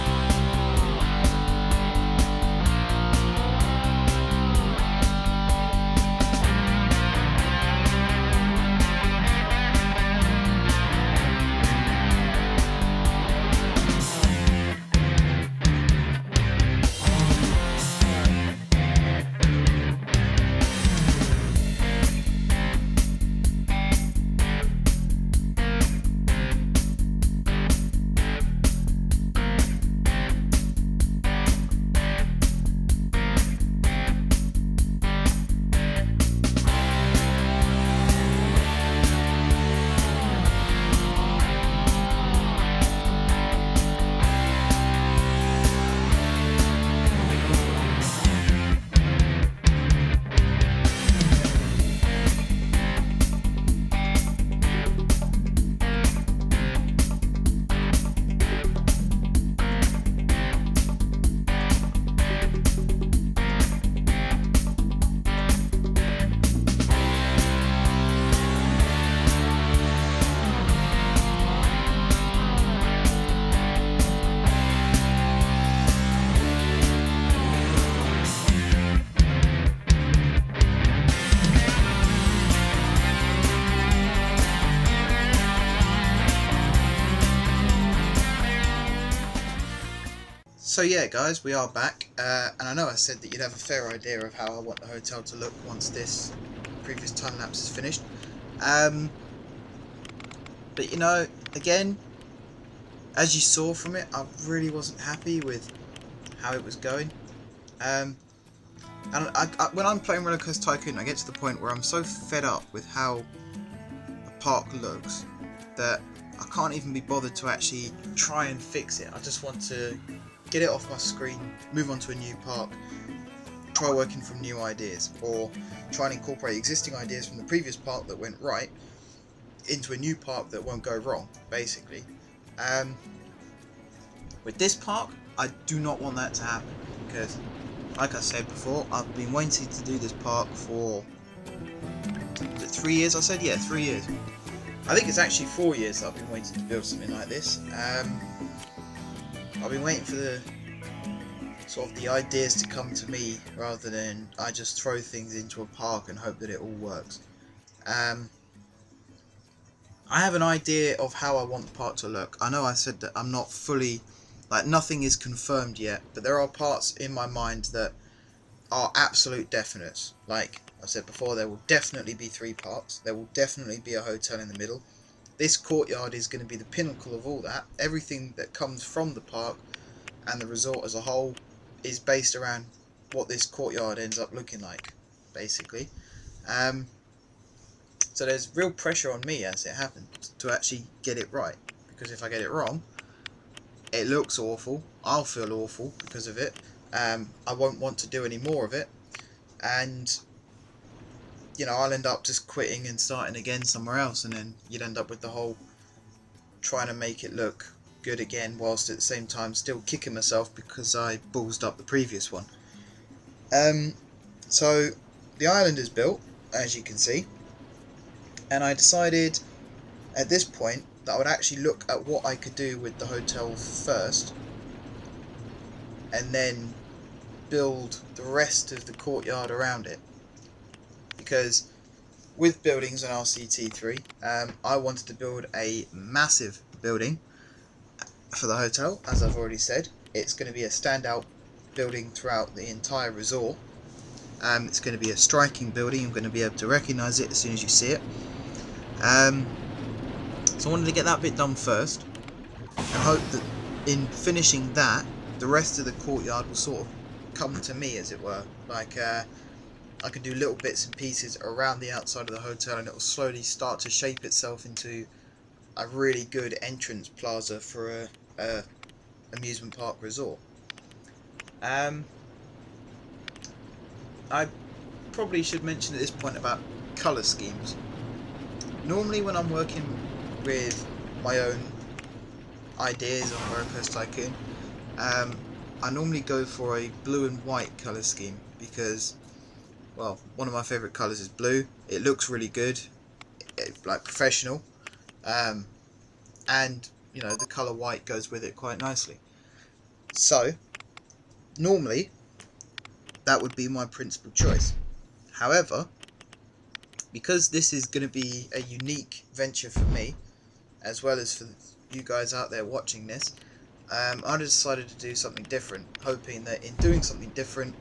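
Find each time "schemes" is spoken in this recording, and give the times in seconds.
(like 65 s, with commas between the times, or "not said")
277 s, 288 s.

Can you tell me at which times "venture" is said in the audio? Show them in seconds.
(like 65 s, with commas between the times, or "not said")
309 s.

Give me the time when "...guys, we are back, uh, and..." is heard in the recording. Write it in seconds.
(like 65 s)
91 s.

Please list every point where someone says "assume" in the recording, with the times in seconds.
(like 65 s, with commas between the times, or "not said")
not said.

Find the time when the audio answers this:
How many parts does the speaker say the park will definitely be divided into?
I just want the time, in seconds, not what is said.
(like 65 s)
172 s.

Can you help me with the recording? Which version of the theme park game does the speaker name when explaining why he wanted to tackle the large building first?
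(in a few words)
RCT3.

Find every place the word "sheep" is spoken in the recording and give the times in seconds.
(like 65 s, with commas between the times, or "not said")
not said.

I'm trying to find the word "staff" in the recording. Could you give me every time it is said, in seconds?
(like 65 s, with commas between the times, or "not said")
not said.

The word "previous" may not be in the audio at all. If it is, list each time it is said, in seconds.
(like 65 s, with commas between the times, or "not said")
96 s, 127 s, 211 s.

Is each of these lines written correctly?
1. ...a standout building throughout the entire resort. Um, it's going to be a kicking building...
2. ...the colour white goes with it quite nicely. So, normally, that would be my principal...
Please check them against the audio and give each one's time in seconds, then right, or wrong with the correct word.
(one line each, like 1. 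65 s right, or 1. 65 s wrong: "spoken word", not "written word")
1. 240 s wrong: "striking", not "kicking"
2. 297 s right.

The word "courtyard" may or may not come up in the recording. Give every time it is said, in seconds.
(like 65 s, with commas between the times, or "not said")
175 s, 183 s, 228 s, 256 s.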